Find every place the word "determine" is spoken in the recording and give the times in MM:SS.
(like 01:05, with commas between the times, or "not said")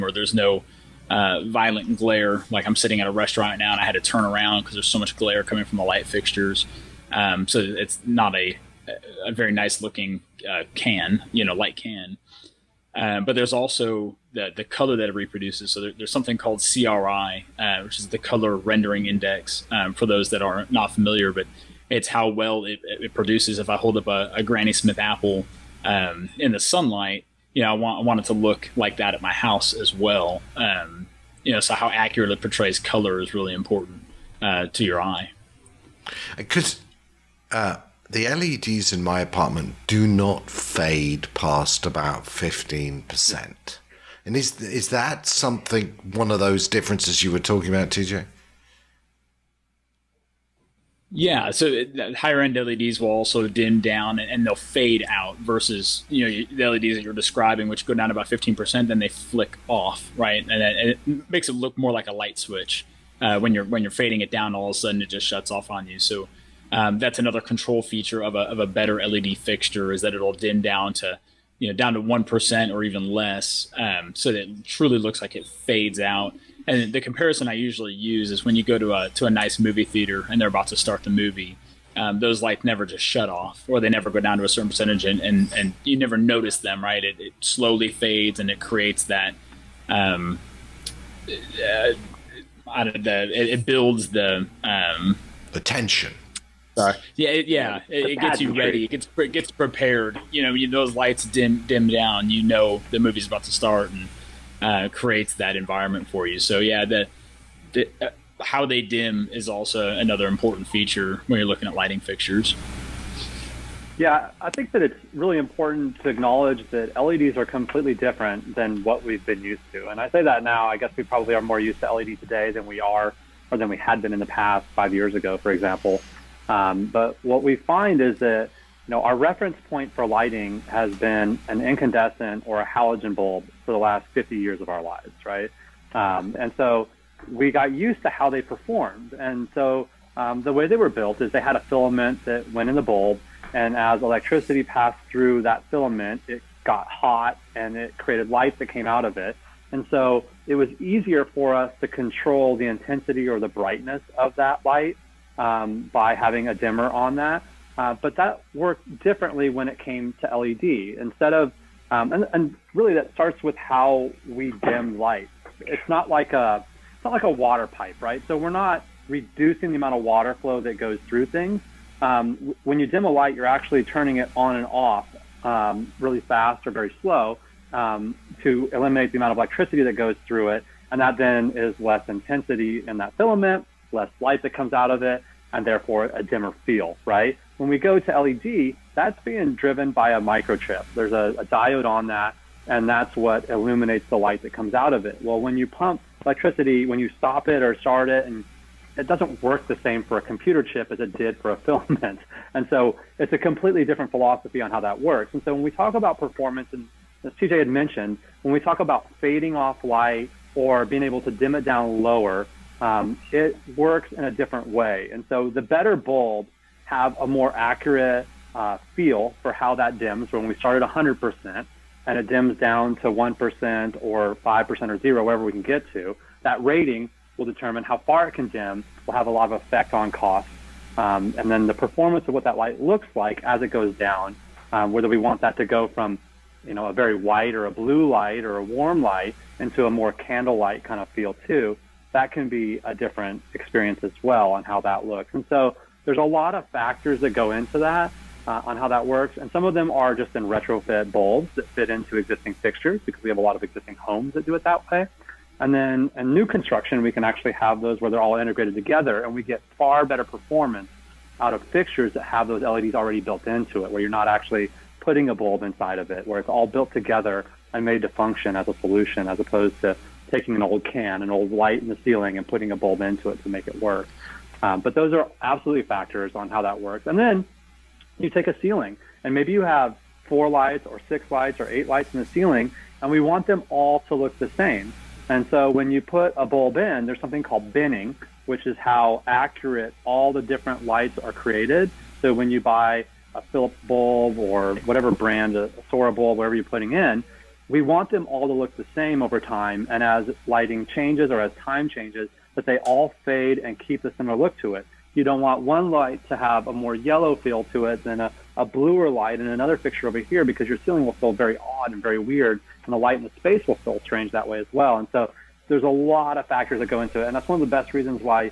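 03:47.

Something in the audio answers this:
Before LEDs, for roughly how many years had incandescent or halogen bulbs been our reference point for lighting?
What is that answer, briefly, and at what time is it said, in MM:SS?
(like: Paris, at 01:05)
50, at 02:14.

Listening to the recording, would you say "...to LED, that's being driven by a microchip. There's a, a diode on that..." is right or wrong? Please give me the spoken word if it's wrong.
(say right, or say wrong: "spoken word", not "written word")
right.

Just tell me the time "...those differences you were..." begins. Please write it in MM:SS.
00:46.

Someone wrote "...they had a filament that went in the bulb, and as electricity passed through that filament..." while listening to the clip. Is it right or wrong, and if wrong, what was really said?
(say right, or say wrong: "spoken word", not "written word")
right.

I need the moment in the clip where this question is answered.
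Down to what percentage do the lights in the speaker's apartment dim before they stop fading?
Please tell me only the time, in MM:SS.
00:42.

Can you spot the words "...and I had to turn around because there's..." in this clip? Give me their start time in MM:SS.
00:03.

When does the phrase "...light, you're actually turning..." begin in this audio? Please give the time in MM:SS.
02:53.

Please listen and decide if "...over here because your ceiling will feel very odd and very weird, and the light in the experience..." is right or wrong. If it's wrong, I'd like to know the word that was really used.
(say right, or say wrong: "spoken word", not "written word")
wrong: "space", not "experience".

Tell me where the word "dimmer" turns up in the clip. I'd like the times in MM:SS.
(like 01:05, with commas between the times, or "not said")
02:36, 03:06.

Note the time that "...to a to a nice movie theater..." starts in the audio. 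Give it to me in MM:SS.
01:18.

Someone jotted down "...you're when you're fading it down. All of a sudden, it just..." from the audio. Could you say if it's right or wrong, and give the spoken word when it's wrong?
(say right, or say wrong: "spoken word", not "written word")
right.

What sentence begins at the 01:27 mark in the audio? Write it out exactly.
It, it slowly fades and it creates that, um, uh, I don't know, it, it builds the um, attention.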